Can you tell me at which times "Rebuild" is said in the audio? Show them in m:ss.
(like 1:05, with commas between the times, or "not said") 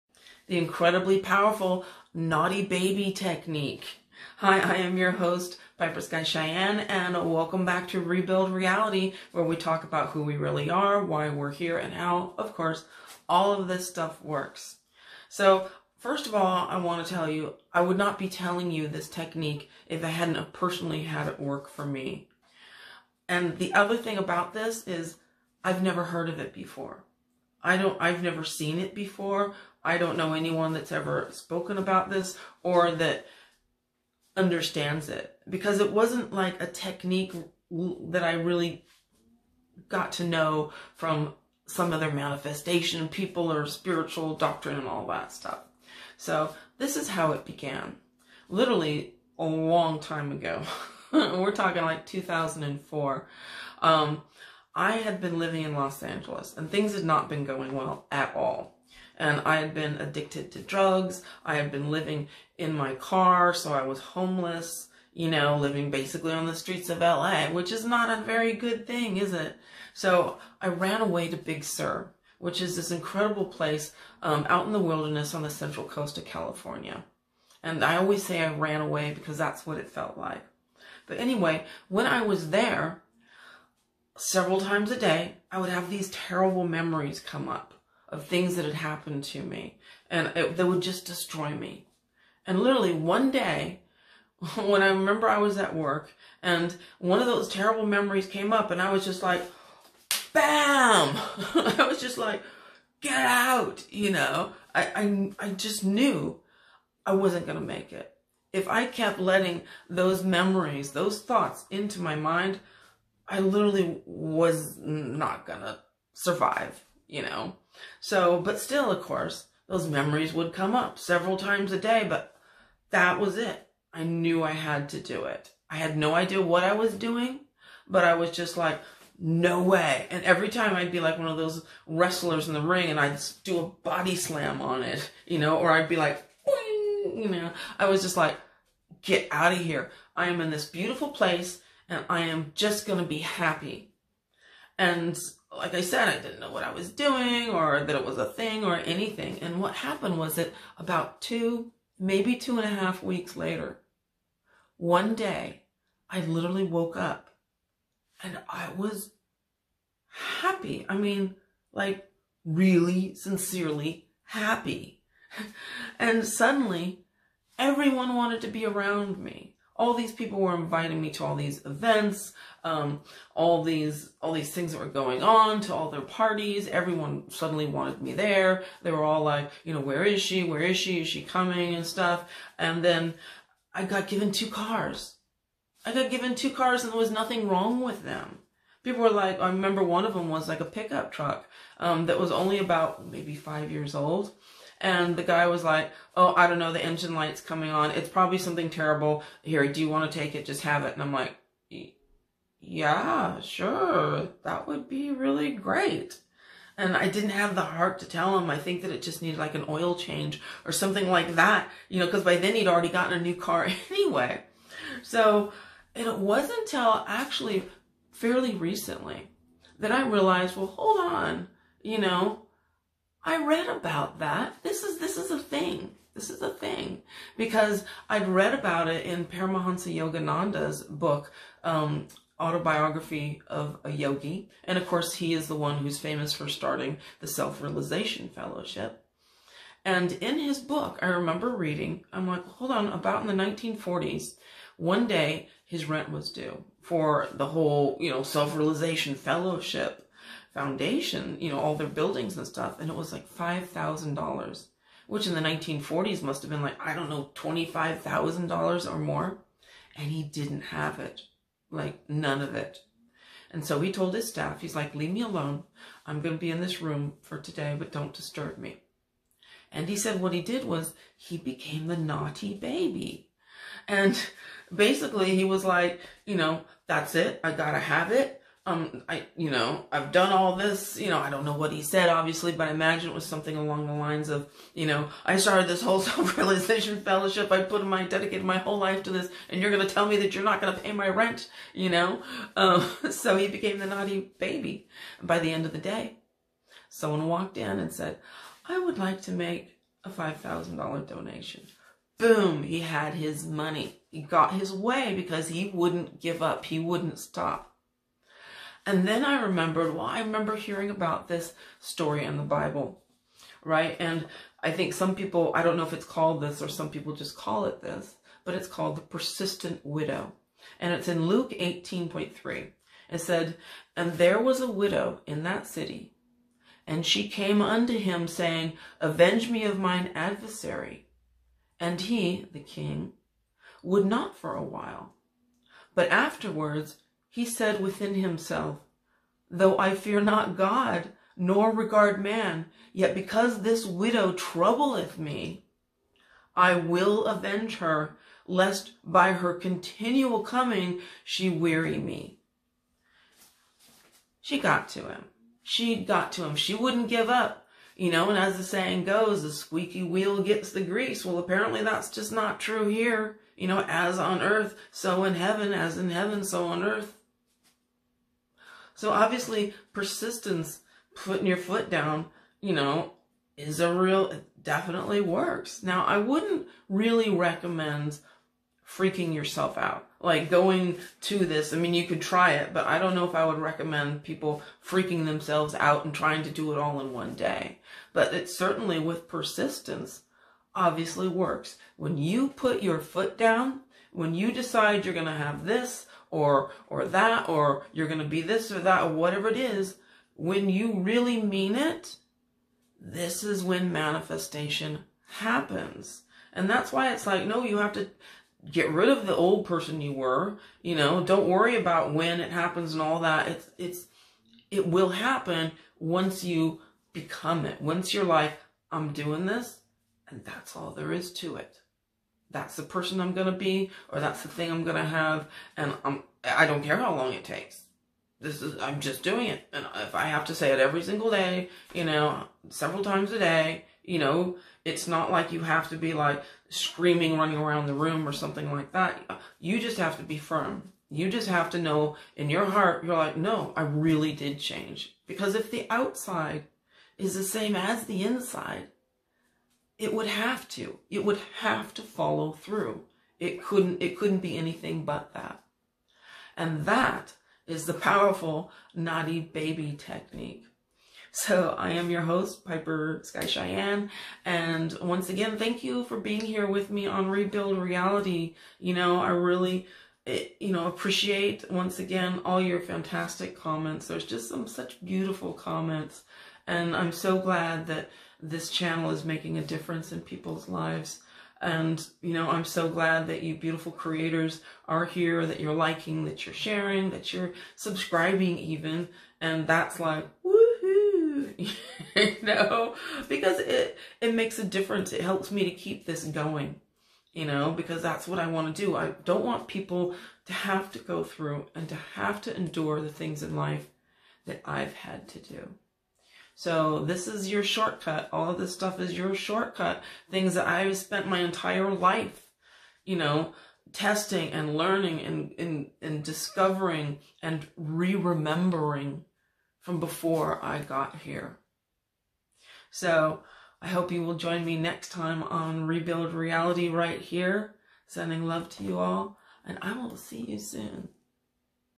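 0:08, 7:47, 8:45.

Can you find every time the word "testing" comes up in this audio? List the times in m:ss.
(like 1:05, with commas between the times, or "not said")
8:33.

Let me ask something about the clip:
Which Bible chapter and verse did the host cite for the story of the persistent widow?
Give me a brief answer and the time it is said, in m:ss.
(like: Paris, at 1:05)
Luke 18:3, at 5:21.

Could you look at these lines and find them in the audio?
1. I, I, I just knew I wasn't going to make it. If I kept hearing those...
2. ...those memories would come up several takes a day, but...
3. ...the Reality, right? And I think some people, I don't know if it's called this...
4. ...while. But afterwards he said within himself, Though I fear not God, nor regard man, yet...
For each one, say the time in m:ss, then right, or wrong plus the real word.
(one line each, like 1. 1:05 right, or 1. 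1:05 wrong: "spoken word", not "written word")
1. 1:44 wrong: "letting", not "hearing"
2. 1:59 wrong: "times", not "takes"
3. 5:12 wrong: "Bible", not "Reality"
4. 5:34 right.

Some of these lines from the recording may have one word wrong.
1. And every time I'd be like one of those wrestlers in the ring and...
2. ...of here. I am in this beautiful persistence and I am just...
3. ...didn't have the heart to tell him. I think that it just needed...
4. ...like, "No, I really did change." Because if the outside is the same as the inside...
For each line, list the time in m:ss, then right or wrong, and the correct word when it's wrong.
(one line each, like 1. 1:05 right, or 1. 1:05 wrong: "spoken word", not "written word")
1. 2:10 right
2. 2:19 wrong: "place", not "persistence"
3. 3:27 right
4. 7:23 right.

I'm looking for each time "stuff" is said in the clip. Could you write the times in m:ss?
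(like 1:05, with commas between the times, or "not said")
0:13, 0:45, 3:01, 4:12, 8:28.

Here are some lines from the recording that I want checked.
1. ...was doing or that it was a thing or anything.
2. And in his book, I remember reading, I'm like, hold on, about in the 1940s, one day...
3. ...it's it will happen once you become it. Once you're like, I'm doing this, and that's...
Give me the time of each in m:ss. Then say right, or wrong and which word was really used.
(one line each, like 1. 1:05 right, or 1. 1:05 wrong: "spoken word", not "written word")
1. 2:26 right
2. 3:59 right
3. 6:53 right.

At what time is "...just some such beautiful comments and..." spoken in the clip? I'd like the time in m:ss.
7:54.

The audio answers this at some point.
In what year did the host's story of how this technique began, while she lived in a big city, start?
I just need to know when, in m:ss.
0:52.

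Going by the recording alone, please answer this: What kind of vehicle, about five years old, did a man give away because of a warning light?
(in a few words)
pickup truck.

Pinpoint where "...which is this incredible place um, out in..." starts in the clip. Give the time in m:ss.
1:12.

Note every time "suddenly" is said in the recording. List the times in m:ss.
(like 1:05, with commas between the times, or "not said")
2:46, 2:57.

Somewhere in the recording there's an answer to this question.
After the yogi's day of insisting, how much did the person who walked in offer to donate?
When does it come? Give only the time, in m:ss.
5:00.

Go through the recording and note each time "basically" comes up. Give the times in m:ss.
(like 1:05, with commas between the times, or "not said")
1:05, 4:34.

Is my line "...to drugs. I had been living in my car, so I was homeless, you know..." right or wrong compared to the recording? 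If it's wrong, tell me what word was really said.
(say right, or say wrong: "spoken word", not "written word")
right.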